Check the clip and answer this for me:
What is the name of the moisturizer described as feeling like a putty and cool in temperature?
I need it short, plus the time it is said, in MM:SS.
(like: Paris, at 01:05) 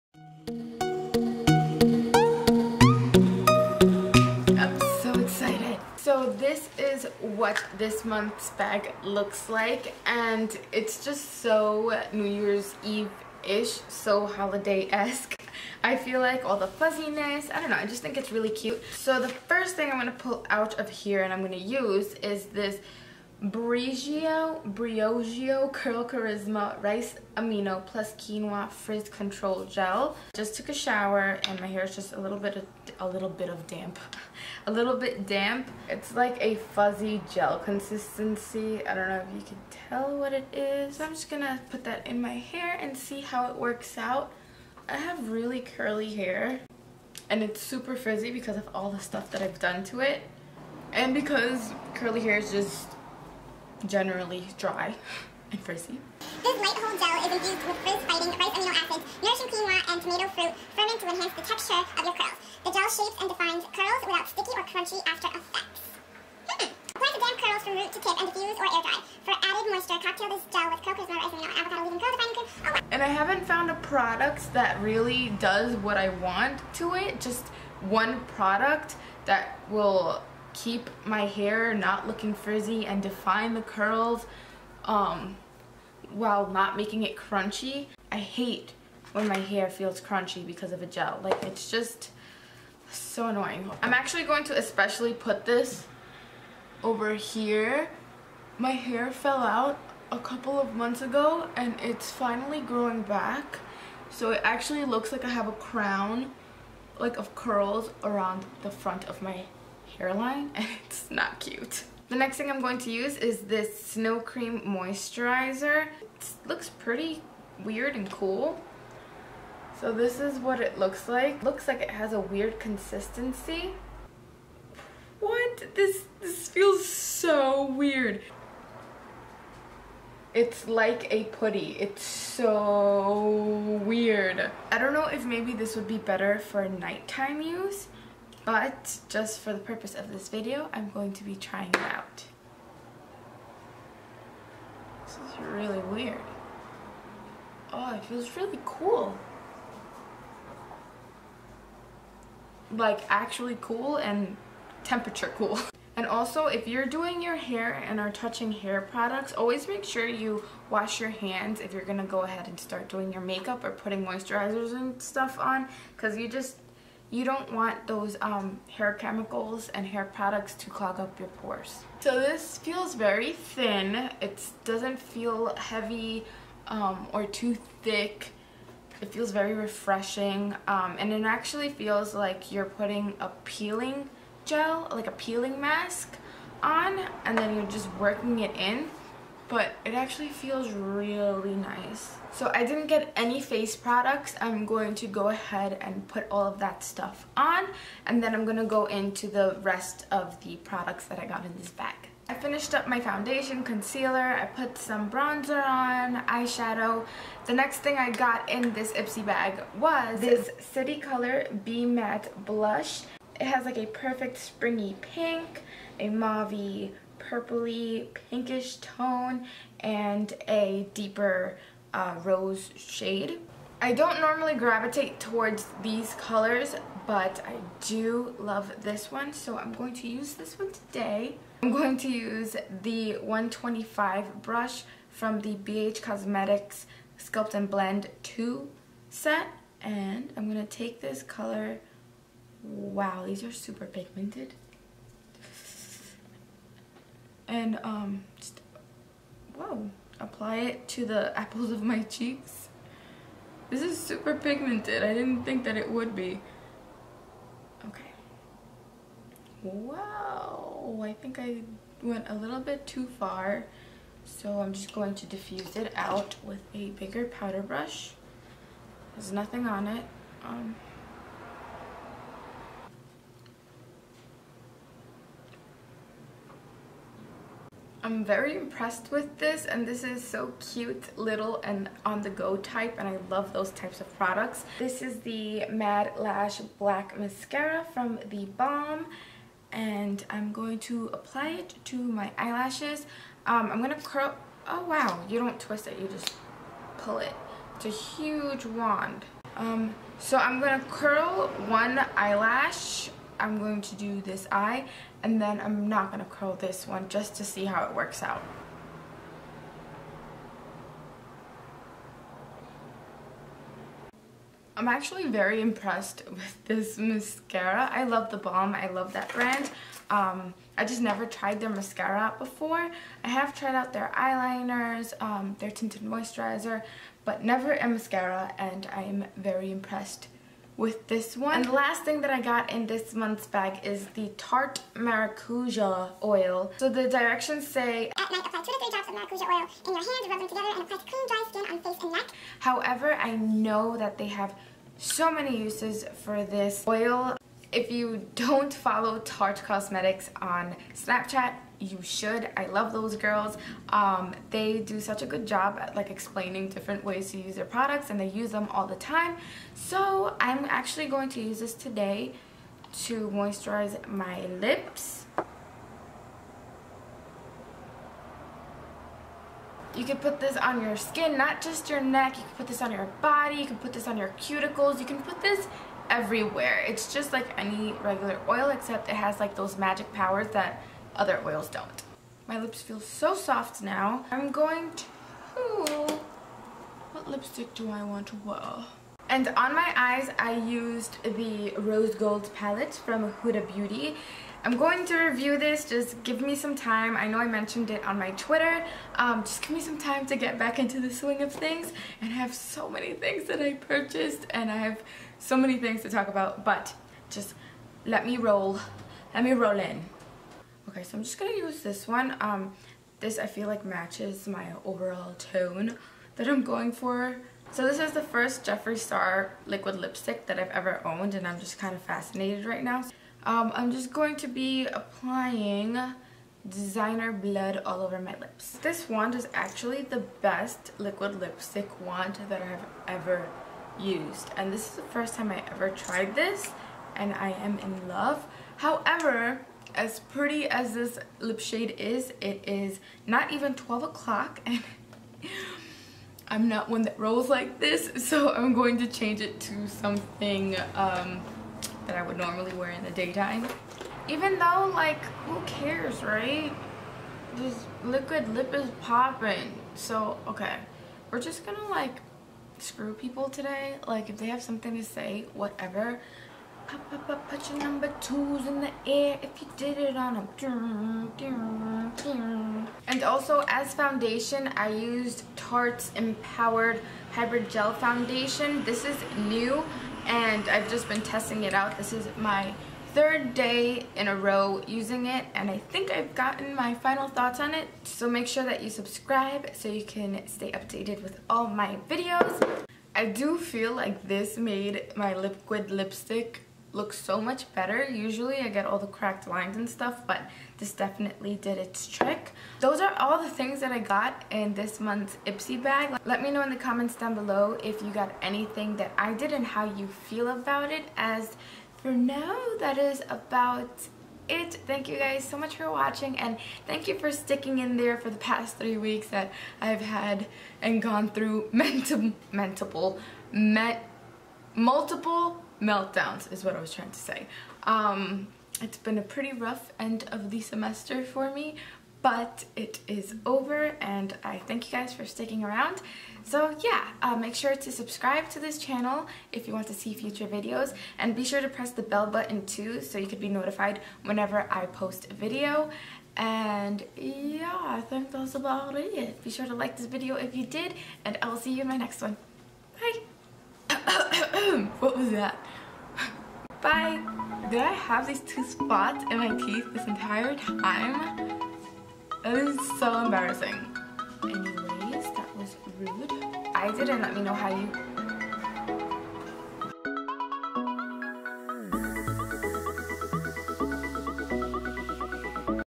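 Snow Cream Moisturizer, at 01:53.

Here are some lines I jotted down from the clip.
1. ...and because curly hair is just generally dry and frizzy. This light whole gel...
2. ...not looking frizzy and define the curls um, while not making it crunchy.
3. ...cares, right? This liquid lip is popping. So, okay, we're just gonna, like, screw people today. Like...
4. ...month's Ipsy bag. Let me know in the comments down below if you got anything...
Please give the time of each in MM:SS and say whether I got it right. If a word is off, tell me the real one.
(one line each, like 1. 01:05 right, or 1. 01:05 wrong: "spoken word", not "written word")
1. 00:50 right
2. 01:21 right
3. 07:35 right
4. 08:24 right.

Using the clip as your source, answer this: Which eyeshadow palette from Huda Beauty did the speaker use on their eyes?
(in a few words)
Rose Gold.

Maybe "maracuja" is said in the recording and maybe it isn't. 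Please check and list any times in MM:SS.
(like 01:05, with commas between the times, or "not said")
05:34, 05:39.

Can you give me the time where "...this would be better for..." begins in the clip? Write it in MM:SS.
02:15.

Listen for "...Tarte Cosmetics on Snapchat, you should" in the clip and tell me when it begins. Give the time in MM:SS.
05:49.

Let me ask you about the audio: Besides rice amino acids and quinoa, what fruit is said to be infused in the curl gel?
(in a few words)
tomato.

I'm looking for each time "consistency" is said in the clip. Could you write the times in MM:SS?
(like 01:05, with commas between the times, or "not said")
00:37, 02:02.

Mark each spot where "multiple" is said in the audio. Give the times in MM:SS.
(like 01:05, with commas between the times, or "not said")
08:44.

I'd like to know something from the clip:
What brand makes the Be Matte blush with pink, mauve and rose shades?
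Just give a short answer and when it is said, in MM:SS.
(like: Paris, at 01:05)
City Color, at 03:30.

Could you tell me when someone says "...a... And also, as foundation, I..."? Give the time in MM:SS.
07:50.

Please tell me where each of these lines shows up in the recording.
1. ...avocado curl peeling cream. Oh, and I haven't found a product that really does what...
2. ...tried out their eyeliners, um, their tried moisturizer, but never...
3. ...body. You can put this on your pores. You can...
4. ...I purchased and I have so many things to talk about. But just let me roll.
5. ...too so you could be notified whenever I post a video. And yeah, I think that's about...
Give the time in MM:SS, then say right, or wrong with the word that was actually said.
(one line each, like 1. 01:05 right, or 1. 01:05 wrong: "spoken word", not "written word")
1. 01:11 wrong: "defining", not "peeling"
2. 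05:23 wrong: "tinted", not "tried"
3. 06:13 wrong: "cuticles", not "pores"
4. 06:43 right
5. 09:02 right.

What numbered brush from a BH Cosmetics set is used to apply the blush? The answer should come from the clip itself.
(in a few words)
125.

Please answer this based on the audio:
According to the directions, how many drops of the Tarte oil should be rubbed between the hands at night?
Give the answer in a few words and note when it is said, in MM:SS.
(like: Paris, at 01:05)
2 to 3, at 05:38.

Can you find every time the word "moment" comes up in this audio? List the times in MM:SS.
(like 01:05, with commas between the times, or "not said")
not said.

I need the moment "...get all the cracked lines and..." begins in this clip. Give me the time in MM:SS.
08:18.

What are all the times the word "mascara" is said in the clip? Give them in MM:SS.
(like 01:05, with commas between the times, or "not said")
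04:47, 05:16, 05:21, 05:27.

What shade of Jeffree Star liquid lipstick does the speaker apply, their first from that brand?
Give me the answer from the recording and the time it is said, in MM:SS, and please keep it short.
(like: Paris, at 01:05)
Designer Blood, at 07:06.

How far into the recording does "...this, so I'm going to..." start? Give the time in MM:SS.
07:27.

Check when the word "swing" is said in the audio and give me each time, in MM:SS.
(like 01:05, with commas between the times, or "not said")
06:41.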